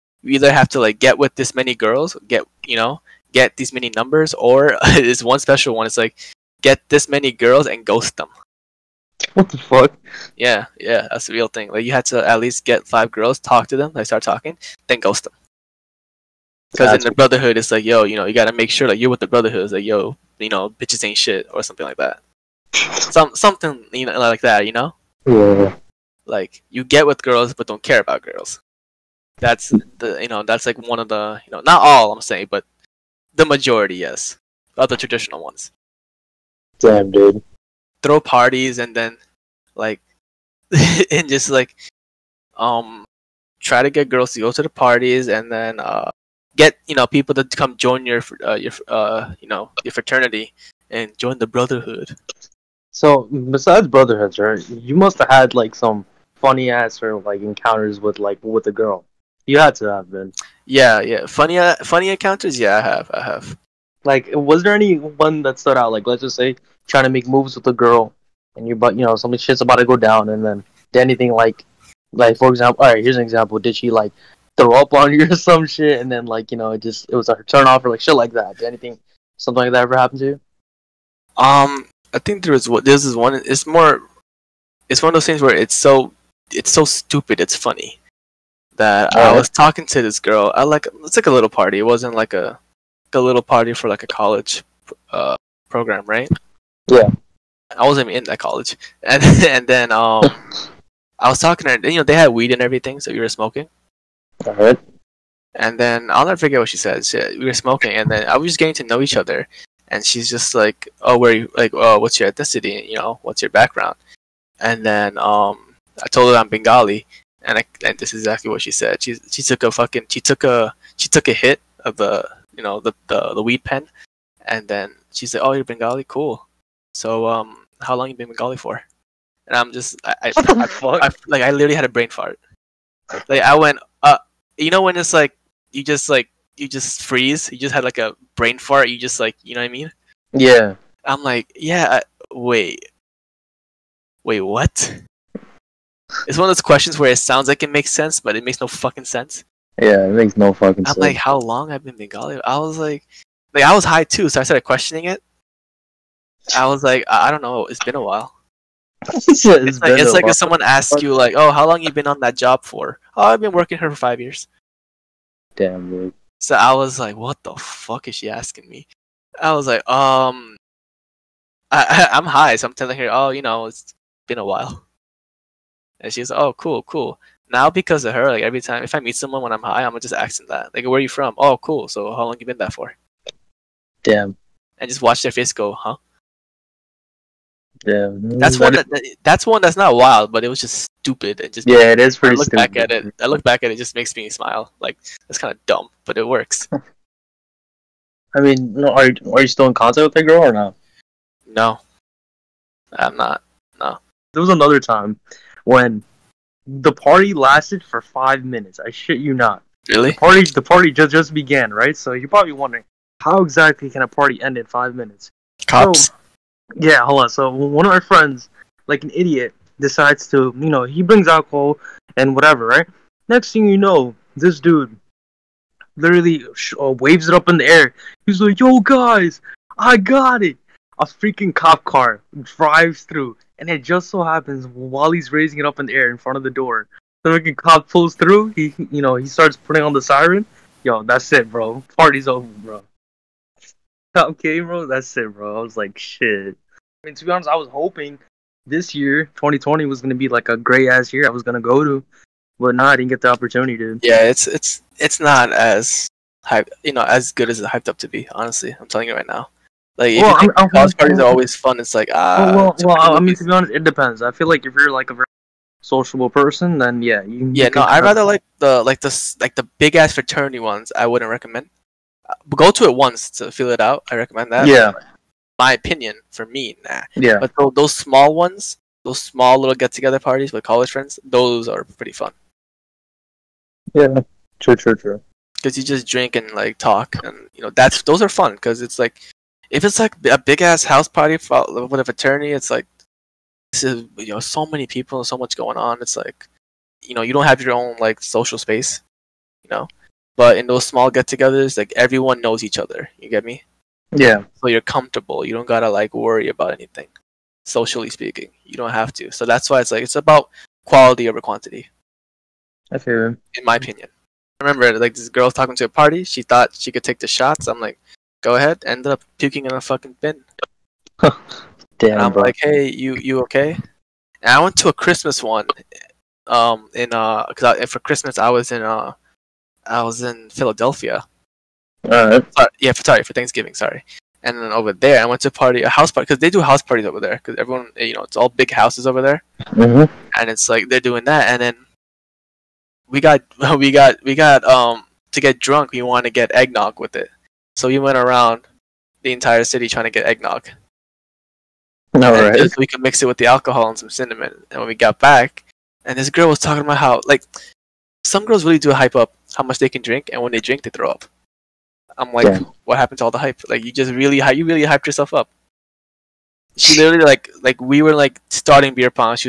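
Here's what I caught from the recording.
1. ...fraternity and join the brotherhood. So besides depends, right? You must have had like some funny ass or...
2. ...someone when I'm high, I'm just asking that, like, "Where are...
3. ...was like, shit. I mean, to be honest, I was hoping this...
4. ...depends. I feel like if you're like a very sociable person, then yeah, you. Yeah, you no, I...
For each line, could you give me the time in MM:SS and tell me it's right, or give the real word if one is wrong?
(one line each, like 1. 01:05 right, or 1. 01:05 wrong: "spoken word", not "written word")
1. 00:49 wrong: "brotherhoods", not "depends"
2. 02:59 right
3. 04:05 right
4. 04:23 right.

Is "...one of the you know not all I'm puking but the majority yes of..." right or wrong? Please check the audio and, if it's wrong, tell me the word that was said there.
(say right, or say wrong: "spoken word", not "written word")
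wrong: "saying", not "puking".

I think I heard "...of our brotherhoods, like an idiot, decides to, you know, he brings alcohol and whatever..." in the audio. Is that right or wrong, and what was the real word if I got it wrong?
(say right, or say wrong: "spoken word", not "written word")
wrong: "friends", not "brotherhoods".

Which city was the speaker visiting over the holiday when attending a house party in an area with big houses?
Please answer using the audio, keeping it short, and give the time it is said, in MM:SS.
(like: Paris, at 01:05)
Philadelphia, at 05:30.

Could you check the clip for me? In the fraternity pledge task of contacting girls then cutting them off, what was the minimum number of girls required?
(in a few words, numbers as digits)
5.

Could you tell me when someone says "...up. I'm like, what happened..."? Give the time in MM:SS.
06:01.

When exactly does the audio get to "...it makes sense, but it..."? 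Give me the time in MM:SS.
02:27.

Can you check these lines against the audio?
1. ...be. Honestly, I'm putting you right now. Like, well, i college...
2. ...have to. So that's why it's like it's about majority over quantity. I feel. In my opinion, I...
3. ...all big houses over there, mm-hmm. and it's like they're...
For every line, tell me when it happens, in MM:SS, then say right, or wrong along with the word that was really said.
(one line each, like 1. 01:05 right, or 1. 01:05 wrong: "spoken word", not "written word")
1. 04:18 wrong: "telling", not "putting"
2. 05:08 wrong: "quality", not "majority"
3. 05:38 right.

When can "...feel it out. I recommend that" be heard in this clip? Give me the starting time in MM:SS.
04:33.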